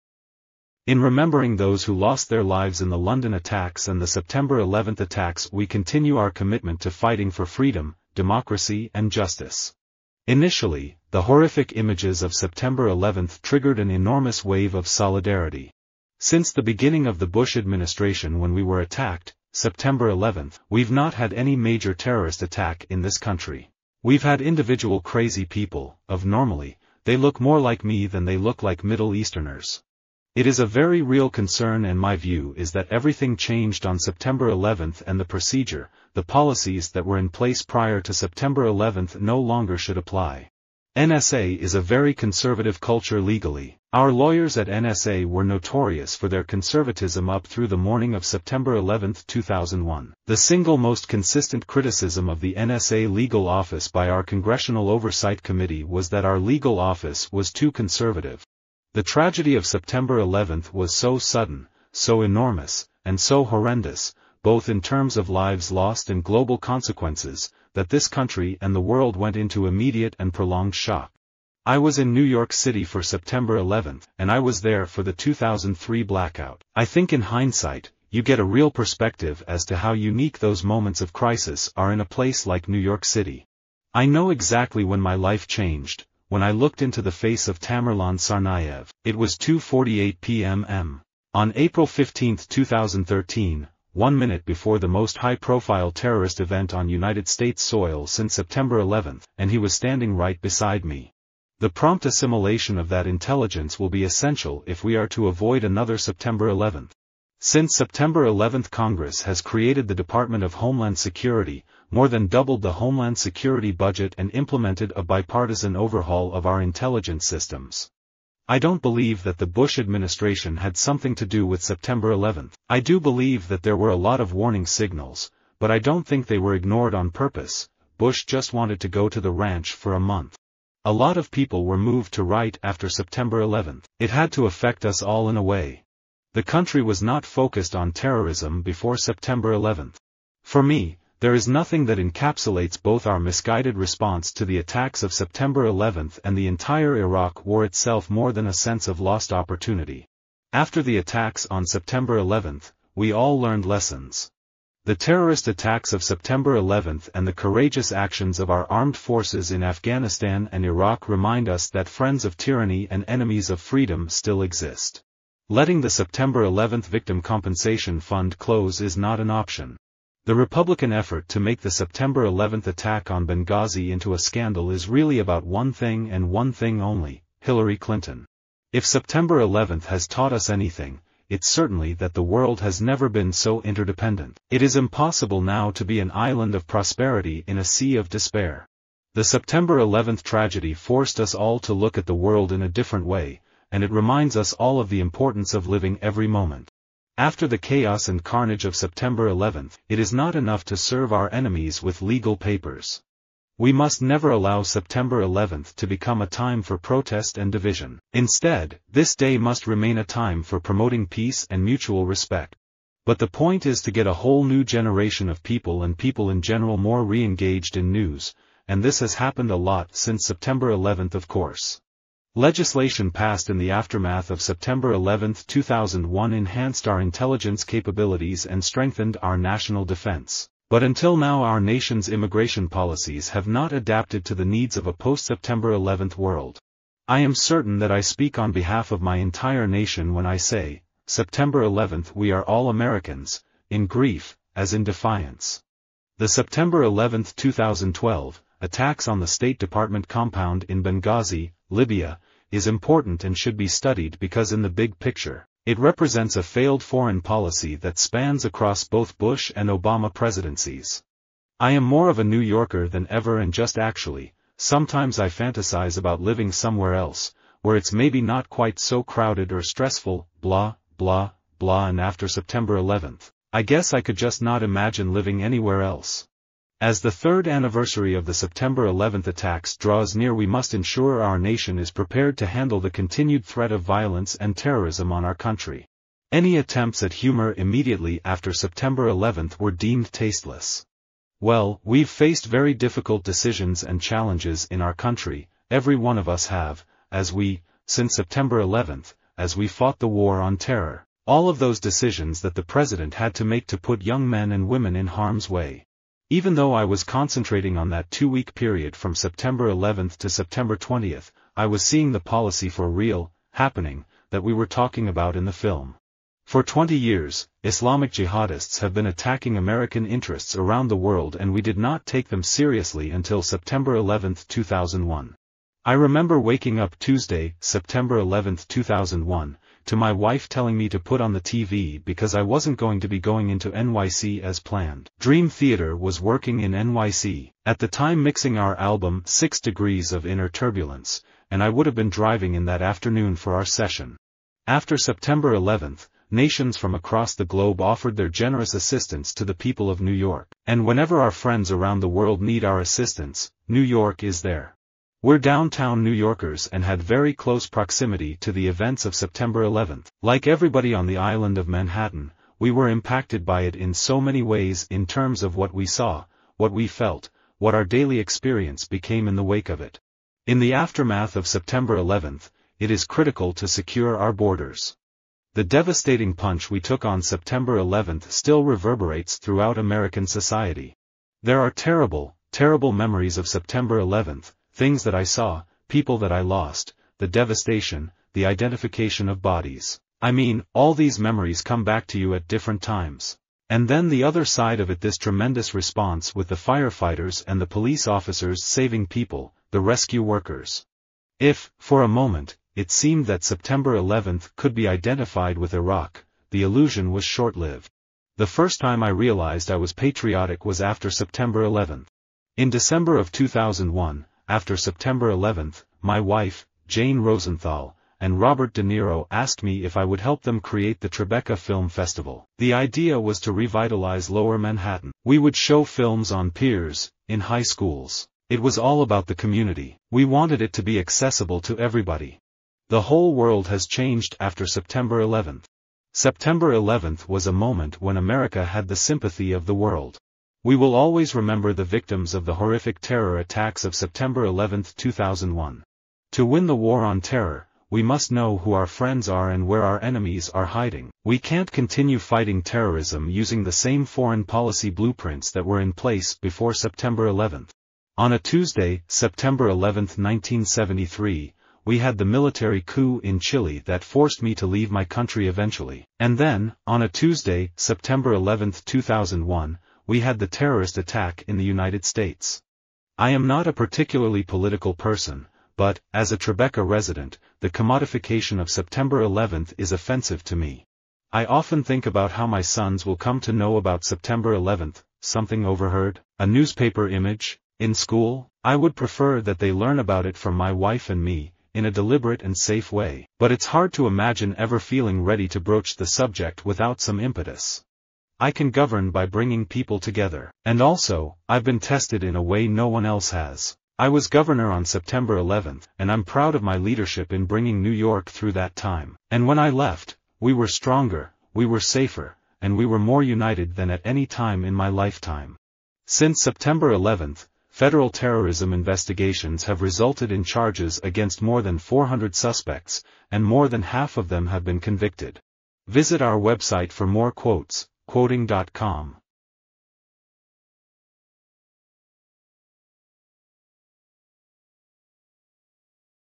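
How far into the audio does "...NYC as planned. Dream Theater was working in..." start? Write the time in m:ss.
5:33.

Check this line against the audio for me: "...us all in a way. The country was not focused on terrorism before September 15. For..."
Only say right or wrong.
wrong.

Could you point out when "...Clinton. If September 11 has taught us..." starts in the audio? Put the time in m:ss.
2:57.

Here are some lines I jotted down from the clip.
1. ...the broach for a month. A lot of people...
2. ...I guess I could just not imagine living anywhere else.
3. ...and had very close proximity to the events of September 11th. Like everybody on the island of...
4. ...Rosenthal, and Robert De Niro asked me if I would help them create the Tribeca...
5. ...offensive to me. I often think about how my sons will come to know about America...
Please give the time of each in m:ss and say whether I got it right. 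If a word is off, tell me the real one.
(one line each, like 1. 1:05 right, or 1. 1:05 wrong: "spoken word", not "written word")
1. 2:09 wrong: "ranch", not "broach"
2. 4:33 right
3. 5:56 right
4. 6:57 right
5. 7:59 wrong: "September", not "America".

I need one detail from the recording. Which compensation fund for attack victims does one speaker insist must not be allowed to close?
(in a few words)
September 11 Victim Compensation Fund.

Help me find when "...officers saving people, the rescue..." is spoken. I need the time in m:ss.
6:38.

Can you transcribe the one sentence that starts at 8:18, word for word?
I can govern by bringing people together.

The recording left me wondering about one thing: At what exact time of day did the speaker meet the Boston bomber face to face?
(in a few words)
2:48 p.m.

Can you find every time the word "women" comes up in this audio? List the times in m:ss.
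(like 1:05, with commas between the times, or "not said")
5:04.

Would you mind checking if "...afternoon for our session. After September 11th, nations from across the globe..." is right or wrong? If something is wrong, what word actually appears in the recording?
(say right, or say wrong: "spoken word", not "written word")
right.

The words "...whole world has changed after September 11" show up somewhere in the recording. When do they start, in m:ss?
7:13.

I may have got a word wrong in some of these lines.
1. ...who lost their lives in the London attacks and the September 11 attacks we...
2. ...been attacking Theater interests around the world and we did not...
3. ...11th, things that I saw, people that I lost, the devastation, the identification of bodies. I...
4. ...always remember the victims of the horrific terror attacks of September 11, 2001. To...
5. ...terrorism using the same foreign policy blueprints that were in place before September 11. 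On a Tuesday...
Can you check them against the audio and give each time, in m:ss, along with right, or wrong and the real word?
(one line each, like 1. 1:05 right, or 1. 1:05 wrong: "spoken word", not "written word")
1. 0:01 right
2. 5:18 wrong: "American", not "Theater"
3. 6:23 right
4. 7:20 right
5. 7:32 right.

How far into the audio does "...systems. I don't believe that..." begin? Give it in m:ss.
1:57.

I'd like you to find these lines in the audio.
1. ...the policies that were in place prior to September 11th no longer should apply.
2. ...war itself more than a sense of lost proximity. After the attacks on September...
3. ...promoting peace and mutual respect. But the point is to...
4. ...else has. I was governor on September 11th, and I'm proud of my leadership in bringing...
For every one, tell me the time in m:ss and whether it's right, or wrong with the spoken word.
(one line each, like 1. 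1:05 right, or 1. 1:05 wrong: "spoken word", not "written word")
1. 0:36 right
2. 2:27 wrong: "opportunity", not "proximity"
3. 3:30 right
4. 8:23 right.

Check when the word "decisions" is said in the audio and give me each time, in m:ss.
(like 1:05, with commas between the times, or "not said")
4:53, 5:01.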